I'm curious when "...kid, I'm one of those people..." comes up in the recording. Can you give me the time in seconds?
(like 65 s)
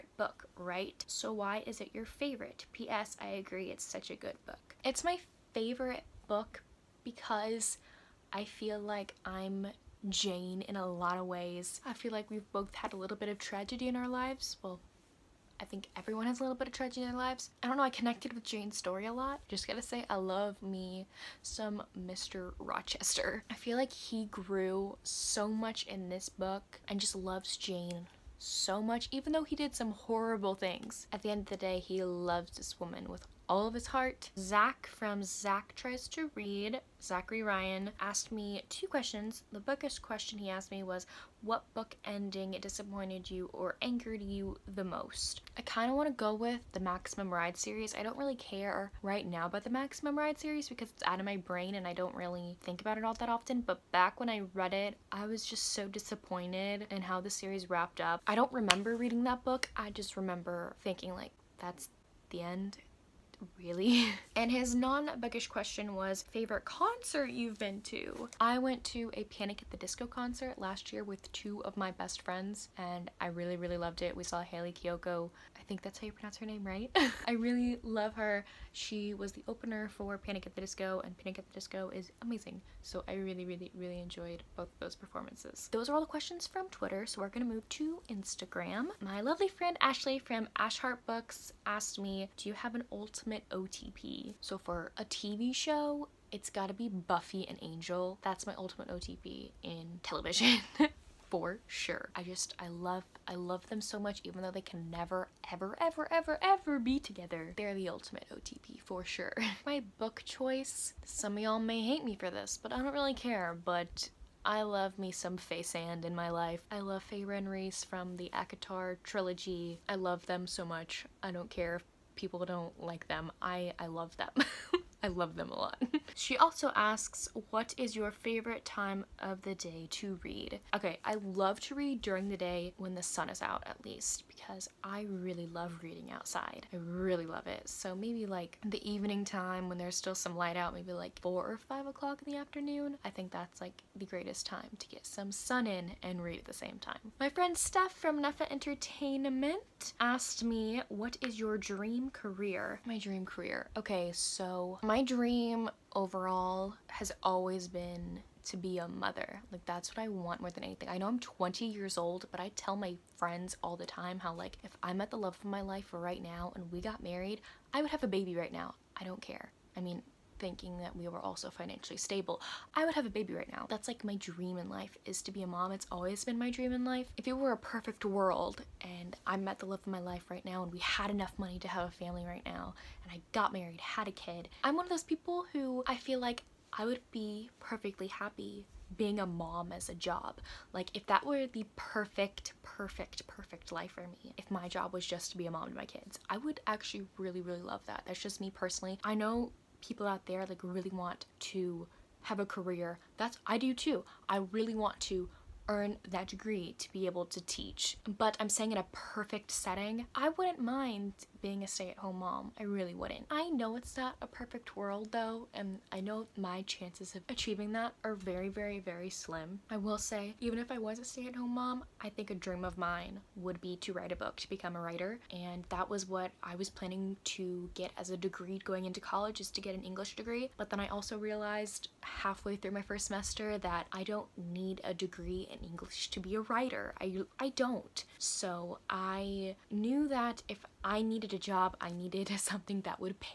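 184 s.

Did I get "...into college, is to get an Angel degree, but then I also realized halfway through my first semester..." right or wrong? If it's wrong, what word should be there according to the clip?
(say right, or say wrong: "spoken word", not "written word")
wrong: "English", not "Angel".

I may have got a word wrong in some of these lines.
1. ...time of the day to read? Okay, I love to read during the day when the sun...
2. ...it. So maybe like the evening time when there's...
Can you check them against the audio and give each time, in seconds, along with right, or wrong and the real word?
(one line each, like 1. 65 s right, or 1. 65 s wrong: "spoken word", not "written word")
1. 128 s right
2. 137 s right.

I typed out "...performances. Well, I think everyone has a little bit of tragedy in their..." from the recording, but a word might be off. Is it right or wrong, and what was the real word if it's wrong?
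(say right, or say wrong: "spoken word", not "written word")
wrong: "lives", not "performances".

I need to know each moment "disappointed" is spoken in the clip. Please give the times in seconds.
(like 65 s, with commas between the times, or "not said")
42 s, 55 s.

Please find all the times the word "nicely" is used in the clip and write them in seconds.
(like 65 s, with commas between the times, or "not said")
not said.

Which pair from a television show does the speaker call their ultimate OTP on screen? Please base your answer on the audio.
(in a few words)
Buffy and Angel.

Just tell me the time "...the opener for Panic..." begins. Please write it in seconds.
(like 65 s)
79 s.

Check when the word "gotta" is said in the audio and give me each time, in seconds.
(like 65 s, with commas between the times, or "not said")
19 s, 96 s.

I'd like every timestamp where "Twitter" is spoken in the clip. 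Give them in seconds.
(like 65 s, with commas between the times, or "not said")
86 s.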